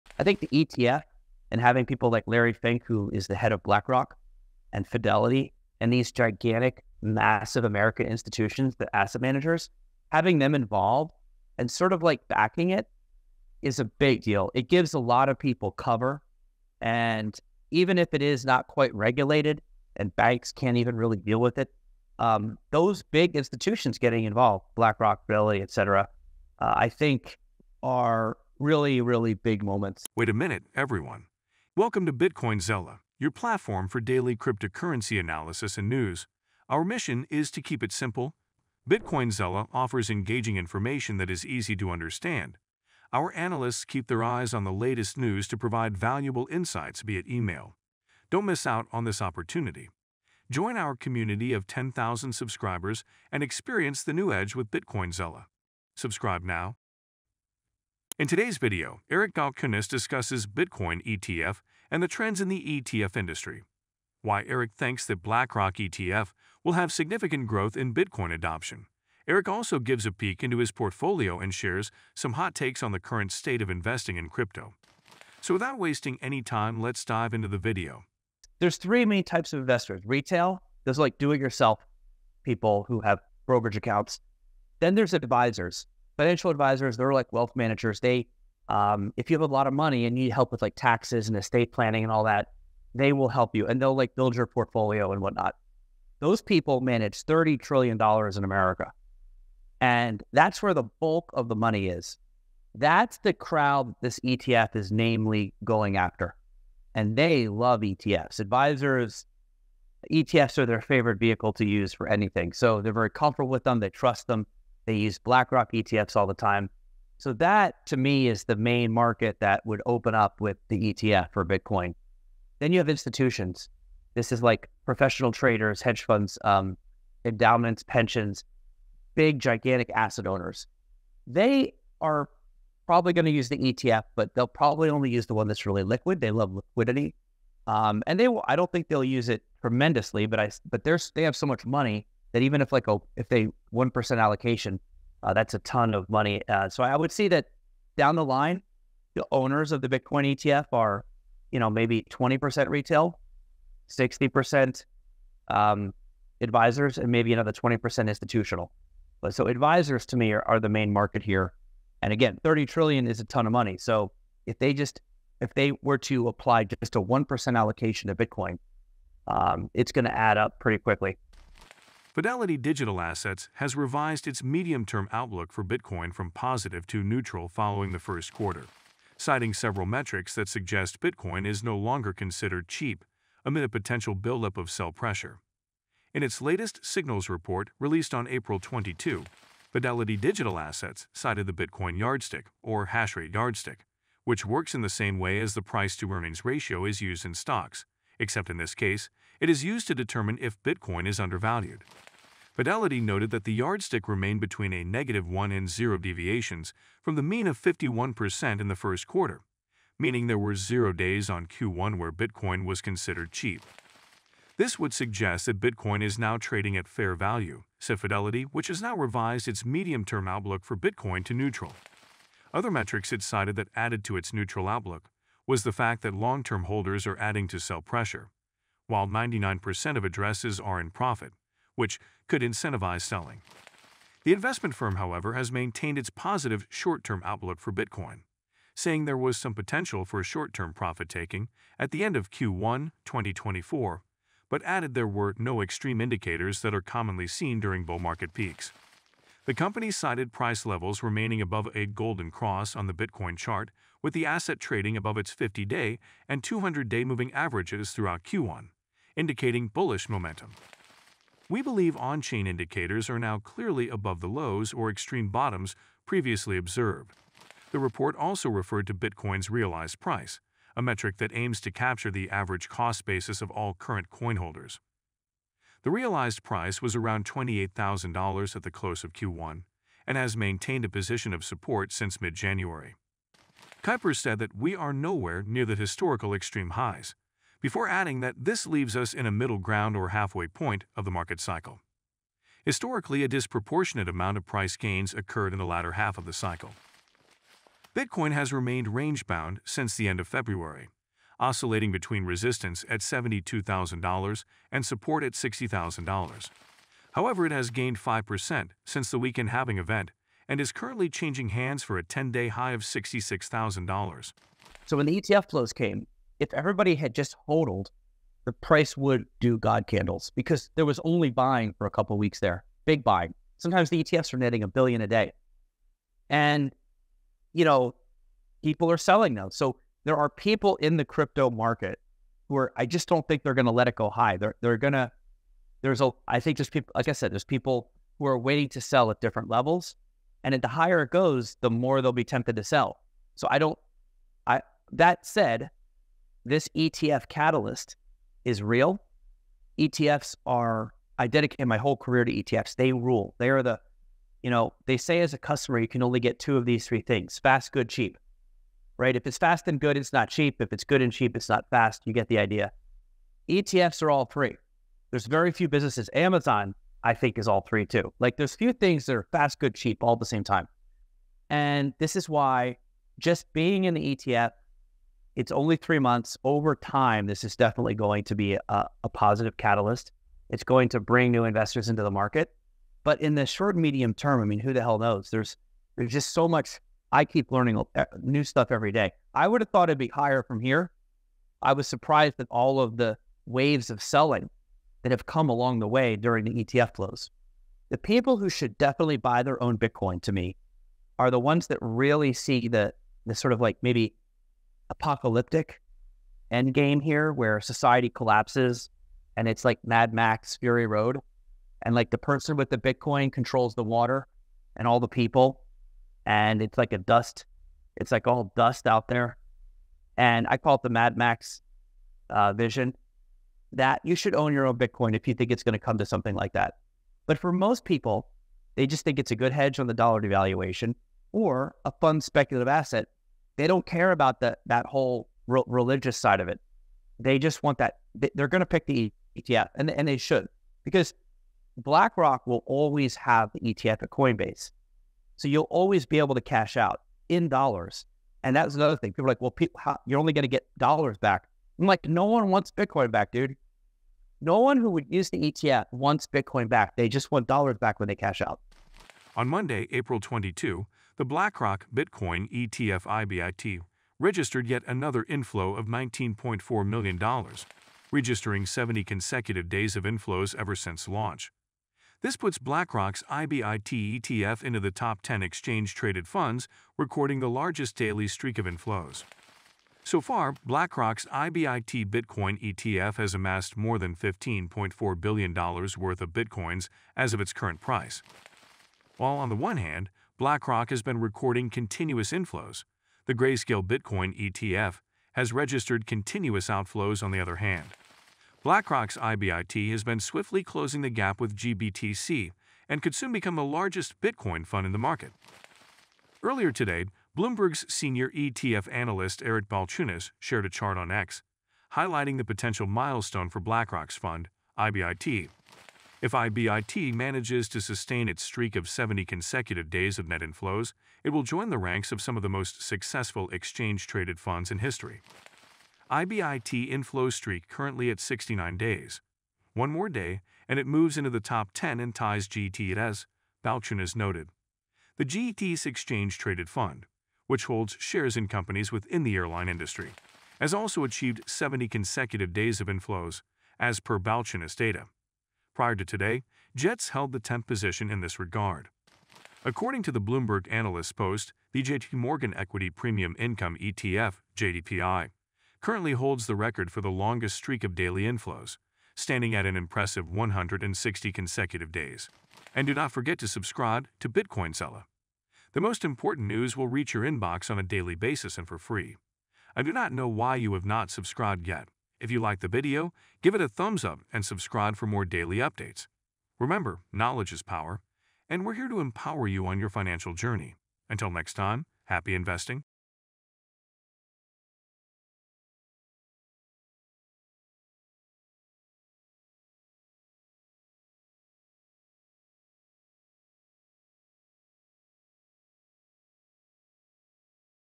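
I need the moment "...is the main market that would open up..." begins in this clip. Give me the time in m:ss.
1:58.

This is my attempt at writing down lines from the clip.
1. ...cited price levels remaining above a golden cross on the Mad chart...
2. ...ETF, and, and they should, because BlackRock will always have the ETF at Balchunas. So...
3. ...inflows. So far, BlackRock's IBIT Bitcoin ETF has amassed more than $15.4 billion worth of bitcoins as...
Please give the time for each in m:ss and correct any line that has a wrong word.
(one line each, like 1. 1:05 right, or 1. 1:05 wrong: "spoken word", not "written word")
1. 4:09 wrong: "Bitcoin", not "Mad"
2. 7:19 wrong: "Coinbase", not "Balchunas"
3. 7:58 right.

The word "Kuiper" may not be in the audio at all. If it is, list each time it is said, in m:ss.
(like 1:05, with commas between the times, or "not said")
4:43.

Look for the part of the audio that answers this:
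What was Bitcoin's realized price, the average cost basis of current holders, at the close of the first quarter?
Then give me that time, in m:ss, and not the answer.
4:37.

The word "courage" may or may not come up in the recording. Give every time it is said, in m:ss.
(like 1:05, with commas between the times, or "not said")
not said.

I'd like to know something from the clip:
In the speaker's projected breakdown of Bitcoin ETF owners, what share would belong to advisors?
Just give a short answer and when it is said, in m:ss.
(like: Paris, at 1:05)
60%, at 2:33.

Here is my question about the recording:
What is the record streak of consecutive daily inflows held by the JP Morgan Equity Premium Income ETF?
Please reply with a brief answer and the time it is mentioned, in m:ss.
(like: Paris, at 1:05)
160 days, at 9:20.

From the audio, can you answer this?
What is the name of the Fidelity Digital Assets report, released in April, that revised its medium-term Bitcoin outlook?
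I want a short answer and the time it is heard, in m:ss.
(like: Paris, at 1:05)
Signals, at 3:06.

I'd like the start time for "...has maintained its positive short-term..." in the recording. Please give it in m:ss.
3:55.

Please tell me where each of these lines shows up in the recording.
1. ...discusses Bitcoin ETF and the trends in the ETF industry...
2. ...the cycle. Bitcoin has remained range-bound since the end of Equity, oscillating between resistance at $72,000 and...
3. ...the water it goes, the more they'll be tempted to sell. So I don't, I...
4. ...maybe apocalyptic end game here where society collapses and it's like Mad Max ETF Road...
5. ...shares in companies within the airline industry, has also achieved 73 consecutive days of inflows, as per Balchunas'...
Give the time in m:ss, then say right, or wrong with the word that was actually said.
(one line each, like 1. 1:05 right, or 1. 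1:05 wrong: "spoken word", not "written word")
1. 0:59 right
2. 4:56 wrong: "February", not "Equity"
3. 5:40 wrong: "higher", not "water"
4. 6:43 wrong: "Fury", not "ETF"
5. 8:57 wrong: "70", not "73".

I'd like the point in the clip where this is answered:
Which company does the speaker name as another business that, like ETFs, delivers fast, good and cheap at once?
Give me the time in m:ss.
6:06.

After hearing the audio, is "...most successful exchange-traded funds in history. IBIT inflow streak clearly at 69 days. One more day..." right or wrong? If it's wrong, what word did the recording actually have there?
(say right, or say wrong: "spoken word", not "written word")
wrong: "currently", not "clearly".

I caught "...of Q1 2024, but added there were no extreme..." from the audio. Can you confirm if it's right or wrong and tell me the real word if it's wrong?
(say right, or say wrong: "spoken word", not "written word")
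right.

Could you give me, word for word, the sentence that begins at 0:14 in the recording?
It gives a lot of people cover.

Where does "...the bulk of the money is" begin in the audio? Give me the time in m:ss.
1:40.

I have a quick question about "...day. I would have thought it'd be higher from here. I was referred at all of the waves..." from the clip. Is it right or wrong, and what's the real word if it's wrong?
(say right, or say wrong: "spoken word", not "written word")
wrong: "surprised", not "referred".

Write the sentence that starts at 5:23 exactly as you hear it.
Sometimes the ETFs are netting a billion a day.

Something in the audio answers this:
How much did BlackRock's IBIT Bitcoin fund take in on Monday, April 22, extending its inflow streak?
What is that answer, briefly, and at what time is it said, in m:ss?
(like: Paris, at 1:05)
$19.4 million, at 7:45.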